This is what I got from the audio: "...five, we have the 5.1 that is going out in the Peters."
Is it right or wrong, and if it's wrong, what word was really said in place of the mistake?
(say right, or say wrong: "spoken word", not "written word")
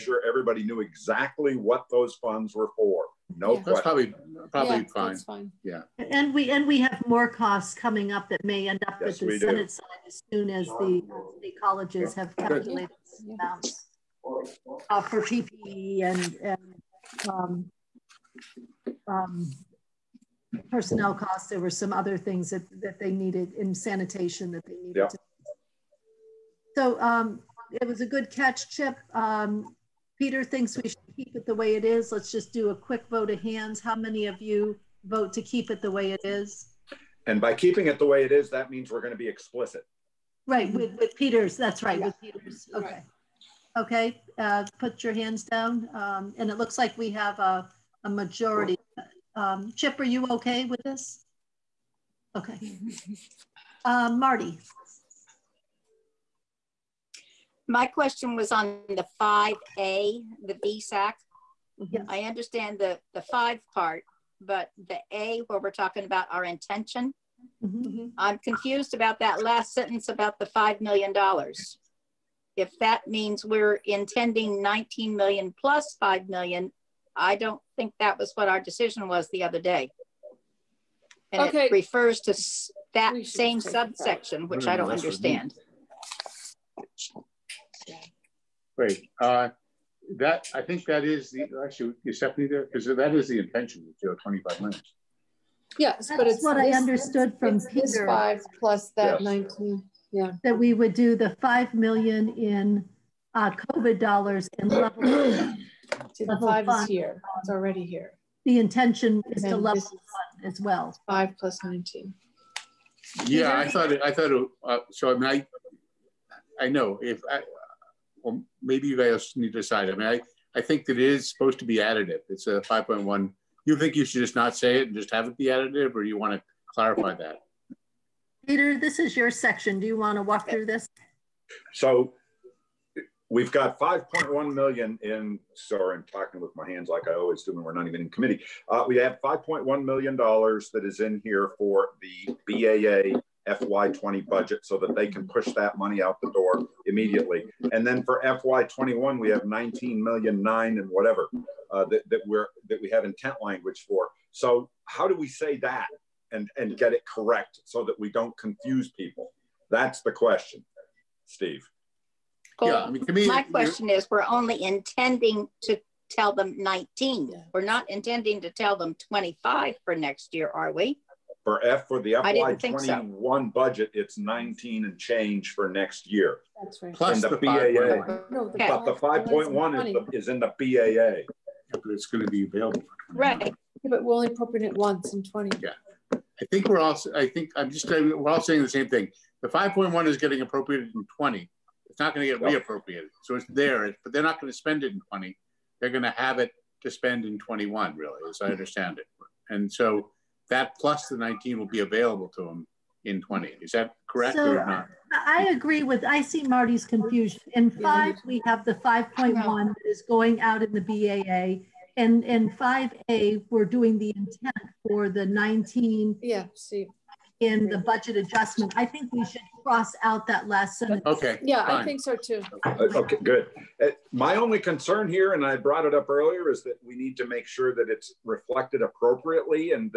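wrong: "BAA", not "Peters".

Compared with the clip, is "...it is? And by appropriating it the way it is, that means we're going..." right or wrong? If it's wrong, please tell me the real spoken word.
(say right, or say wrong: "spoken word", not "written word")
wrong: "keeping", not "appropriating".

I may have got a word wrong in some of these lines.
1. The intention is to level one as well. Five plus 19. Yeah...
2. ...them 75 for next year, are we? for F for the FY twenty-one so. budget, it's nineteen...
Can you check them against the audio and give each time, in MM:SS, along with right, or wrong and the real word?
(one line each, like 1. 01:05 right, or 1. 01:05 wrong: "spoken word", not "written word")
1. 01:48 right
2. 02:48 wrong: "25", not "75".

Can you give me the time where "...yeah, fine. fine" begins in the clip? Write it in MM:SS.
00:04.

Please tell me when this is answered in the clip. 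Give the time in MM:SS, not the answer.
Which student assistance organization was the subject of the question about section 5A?
01:00.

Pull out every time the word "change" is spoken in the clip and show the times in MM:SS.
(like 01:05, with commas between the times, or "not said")
02:54.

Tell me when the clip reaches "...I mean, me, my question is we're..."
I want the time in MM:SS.
02:42.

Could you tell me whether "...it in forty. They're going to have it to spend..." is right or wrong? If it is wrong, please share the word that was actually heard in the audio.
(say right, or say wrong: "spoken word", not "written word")
wrong: "twenty", not "forty".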